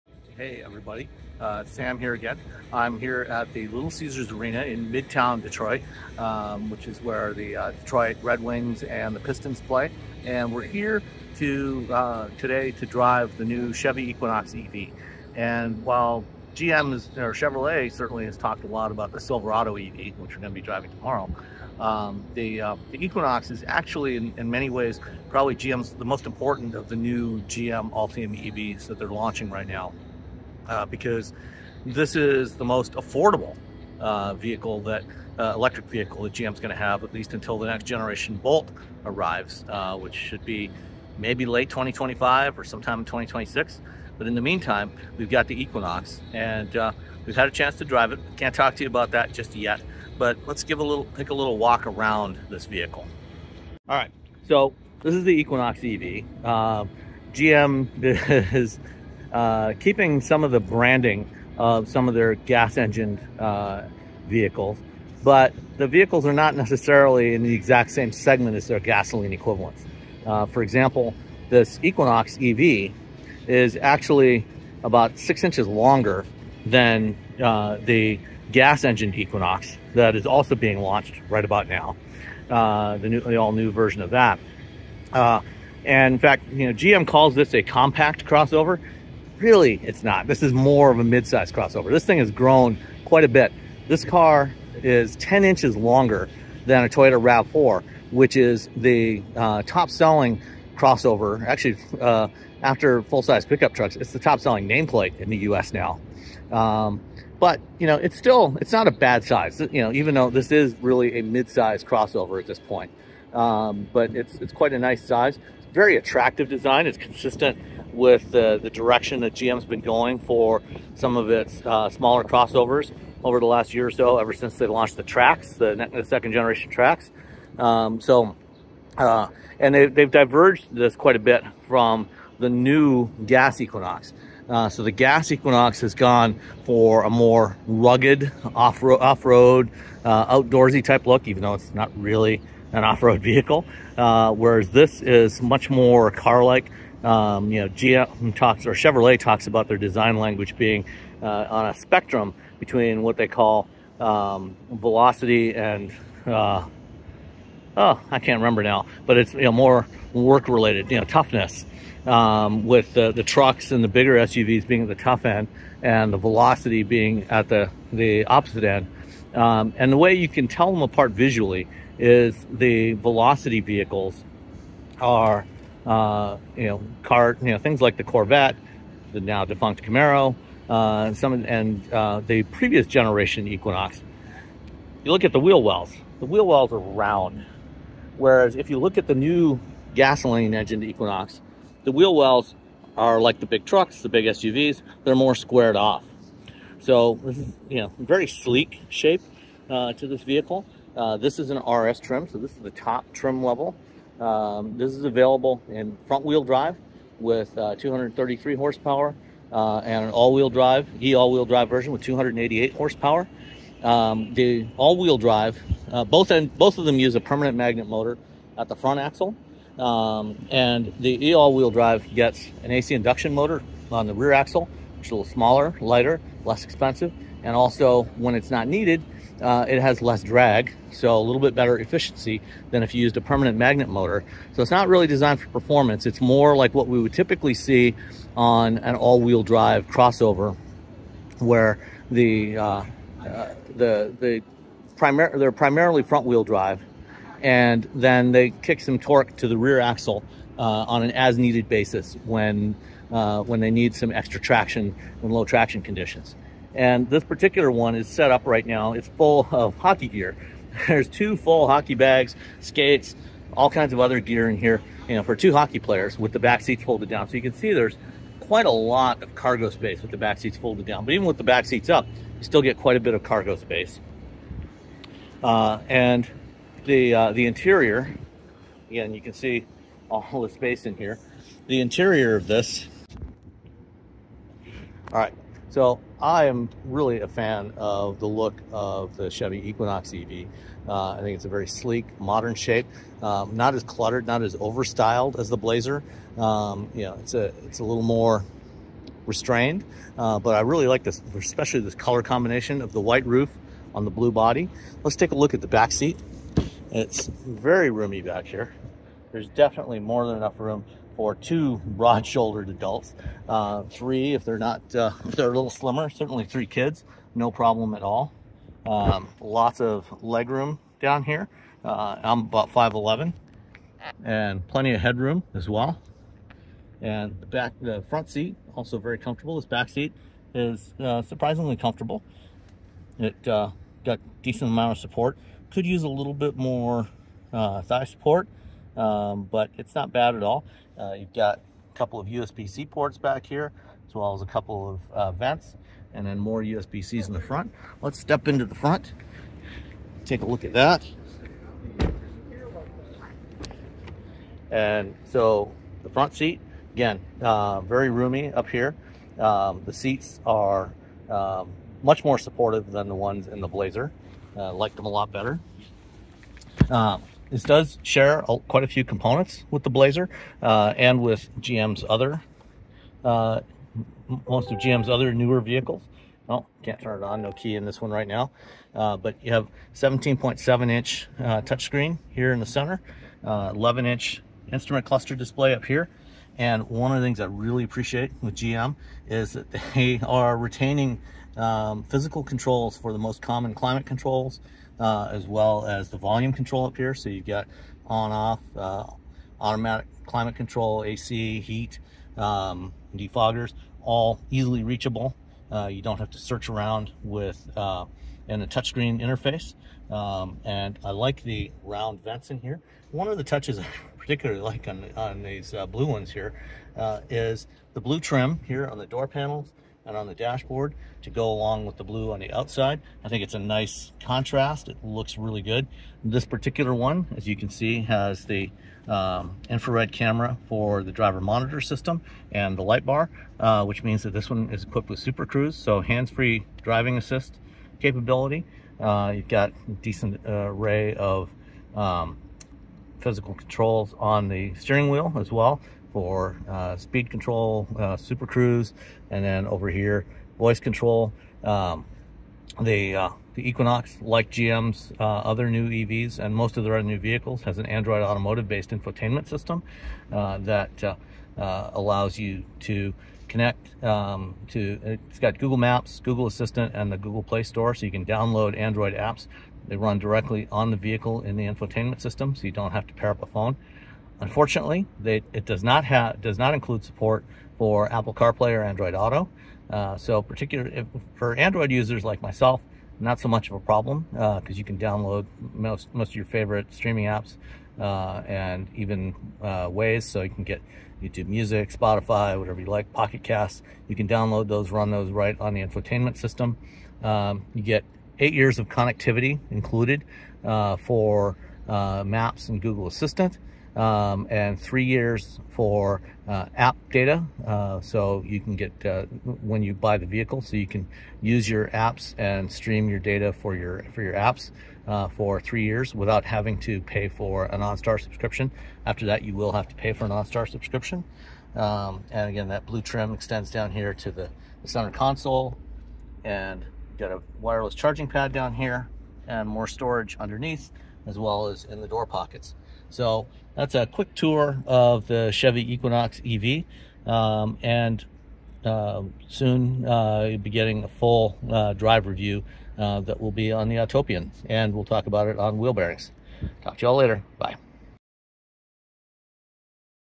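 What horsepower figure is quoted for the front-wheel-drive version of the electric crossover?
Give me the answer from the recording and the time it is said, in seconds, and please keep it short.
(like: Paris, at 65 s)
233, at 207 s.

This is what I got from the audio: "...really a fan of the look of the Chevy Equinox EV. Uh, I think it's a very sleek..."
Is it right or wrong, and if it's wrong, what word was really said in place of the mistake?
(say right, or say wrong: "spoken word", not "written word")
right.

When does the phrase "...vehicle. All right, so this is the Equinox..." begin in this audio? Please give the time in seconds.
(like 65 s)
52 s.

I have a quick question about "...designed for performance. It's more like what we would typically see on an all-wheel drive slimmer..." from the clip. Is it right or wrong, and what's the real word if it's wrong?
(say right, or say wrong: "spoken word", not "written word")
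wrong: "crossover", not "slimmer".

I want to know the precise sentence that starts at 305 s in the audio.
Let's take a look at the back seat.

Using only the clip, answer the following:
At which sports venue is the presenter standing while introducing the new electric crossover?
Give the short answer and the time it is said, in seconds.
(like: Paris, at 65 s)
Little Caesars Arena, at 3 s.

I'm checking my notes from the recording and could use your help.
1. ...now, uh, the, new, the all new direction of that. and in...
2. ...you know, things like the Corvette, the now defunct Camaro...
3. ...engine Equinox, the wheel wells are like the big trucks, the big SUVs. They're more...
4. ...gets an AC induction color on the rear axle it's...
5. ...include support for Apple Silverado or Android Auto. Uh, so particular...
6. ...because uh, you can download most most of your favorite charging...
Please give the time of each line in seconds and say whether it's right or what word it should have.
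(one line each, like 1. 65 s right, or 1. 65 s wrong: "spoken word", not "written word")
1. 81 s wrong: "version", not "direction"
2. 177 s right
3. 190 s right
4. 222 s wrong: "motor", not "color"
5. 476 s wrong: "CarPlay", not "Silverado"
6. 484 s wrong: "streaming", not "charging".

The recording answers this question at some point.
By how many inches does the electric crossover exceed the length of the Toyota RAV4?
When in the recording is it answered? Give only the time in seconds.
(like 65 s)
95 s.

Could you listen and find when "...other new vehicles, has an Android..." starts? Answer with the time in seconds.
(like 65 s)
456 s.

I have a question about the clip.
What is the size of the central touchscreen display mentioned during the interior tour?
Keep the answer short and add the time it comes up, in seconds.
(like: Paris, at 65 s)
17.7 inch, at 379 s.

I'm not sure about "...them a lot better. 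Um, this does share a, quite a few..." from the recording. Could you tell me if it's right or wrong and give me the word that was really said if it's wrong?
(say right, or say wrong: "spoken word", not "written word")
right.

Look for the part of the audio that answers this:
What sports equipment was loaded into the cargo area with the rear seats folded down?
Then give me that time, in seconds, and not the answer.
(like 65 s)
259 s.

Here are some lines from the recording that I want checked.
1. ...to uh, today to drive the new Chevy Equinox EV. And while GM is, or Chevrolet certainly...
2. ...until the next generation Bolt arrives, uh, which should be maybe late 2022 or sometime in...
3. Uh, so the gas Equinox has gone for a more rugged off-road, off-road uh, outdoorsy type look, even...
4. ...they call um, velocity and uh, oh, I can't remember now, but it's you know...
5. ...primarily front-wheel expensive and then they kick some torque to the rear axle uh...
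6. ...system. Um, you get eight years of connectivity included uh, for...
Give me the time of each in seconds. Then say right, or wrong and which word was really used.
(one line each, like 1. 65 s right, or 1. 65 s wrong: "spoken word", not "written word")
1. 11 s right
2. 37 s wrong: "2025", not "2022"
3. 134 s right
4. 153 s right
5. 245 s wrong: "drive", not "expensive"
6. 496 s right.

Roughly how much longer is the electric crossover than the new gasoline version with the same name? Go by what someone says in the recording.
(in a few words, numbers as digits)
6 inches.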